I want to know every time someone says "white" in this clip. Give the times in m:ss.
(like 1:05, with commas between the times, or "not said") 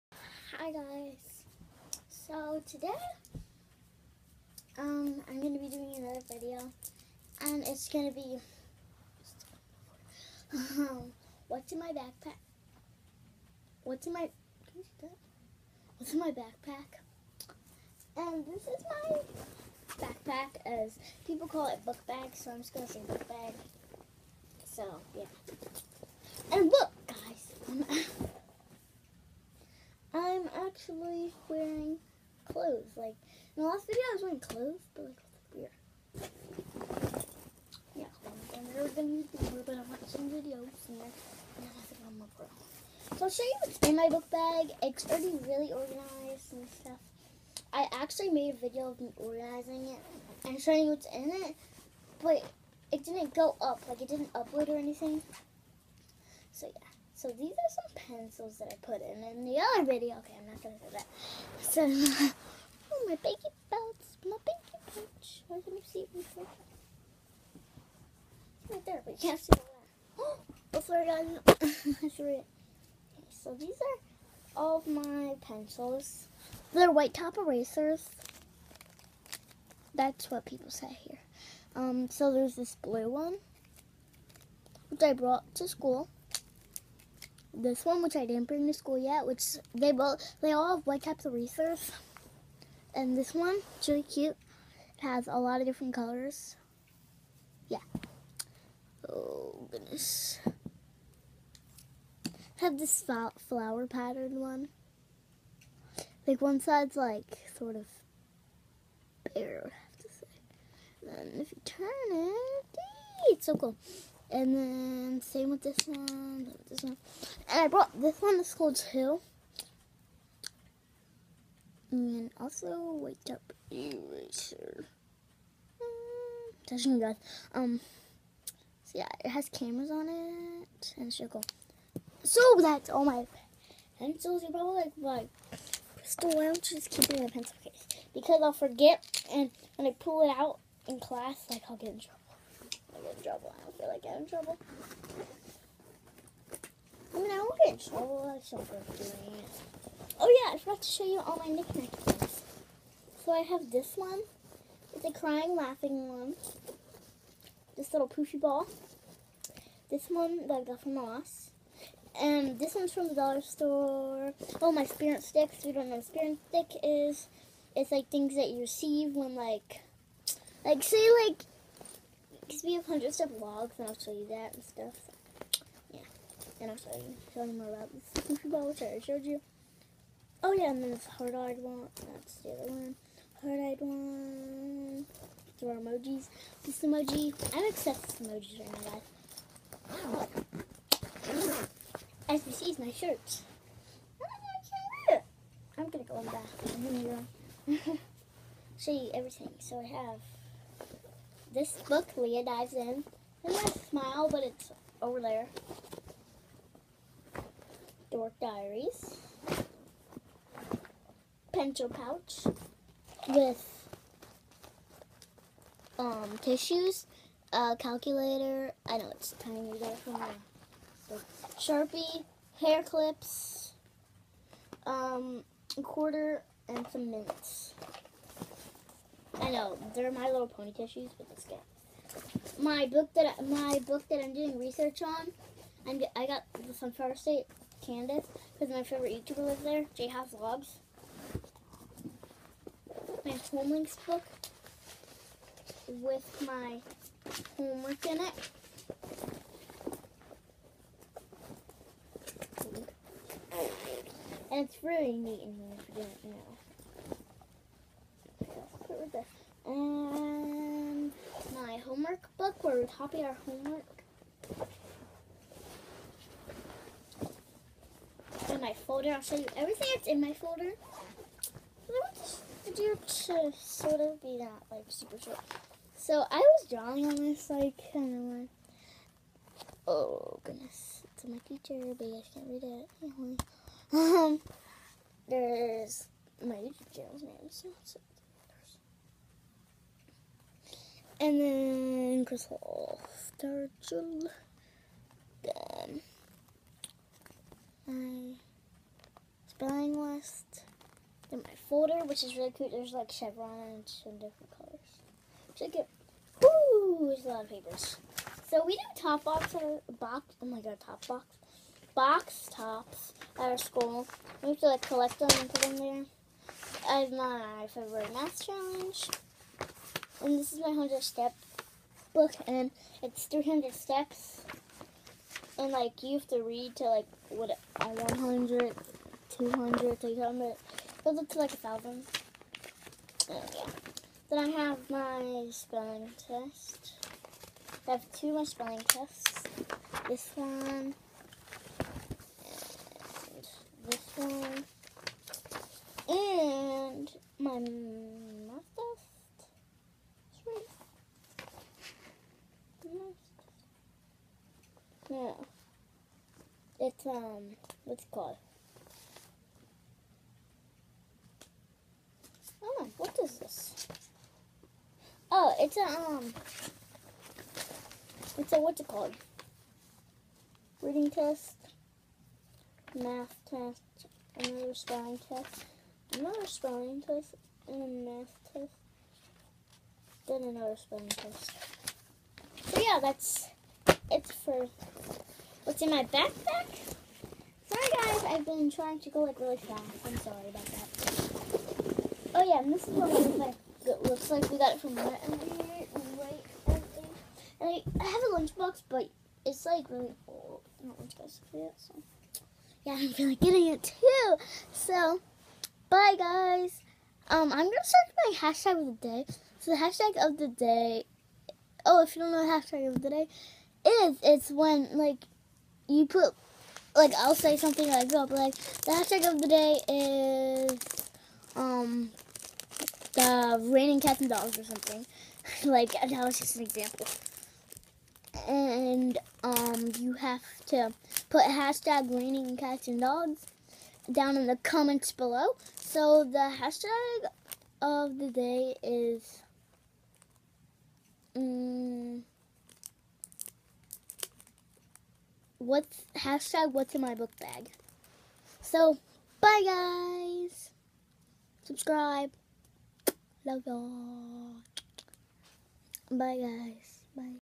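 1:16, 1:30.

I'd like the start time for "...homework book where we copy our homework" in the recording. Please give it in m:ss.
4:21.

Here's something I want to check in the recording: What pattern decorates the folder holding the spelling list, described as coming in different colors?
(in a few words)
chevrons.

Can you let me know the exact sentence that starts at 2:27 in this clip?
I mean, I won't get in trouble.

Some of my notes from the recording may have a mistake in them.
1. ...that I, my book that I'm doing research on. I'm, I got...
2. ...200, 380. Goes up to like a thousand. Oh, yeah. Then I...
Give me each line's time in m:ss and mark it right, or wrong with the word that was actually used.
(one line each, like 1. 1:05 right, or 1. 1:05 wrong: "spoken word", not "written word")
1. 3:53 right
2. 5:29 wrong: "300", not "380".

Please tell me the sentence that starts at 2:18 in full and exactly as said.
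Because I'll forget, and when I pull it out in class, like I'll get in trouble.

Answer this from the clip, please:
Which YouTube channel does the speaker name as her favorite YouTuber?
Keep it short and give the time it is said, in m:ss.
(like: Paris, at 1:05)
J House Vlogs, at 3:59.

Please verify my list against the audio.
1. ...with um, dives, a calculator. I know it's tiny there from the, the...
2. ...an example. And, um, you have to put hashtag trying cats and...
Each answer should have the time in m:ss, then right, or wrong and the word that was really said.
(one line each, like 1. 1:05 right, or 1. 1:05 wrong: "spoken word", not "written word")
1. 3:33 wrong: "tissues", not "dives"
2. 7:06 wrong: "raining", not "trying".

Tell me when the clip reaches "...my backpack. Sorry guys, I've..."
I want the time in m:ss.
6:25.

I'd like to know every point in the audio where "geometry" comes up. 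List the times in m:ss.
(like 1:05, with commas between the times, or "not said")
not said.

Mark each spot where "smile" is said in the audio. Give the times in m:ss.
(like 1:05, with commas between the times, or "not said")
3:23.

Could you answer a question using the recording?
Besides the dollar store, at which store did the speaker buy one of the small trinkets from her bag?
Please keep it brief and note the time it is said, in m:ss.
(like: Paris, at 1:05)
Ross, at 2:40.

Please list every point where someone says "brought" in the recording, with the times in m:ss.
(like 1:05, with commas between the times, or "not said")
1:25, 1:57.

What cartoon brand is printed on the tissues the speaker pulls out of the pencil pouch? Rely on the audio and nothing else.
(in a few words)
My Little Pony.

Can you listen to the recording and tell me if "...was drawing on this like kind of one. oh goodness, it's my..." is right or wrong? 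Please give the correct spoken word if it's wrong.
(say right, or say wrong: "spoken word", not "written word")
right.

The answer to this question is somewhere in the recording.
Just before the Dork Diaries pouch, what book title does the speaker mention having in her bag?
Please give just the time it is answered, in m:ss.
3:22.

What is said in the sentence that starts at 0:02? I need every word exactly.
So today, um, I'm gonna be doing another video, and it's gonna be um, what's in my backpack?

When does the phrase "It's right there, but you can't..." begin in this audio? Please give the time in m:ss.
1:08.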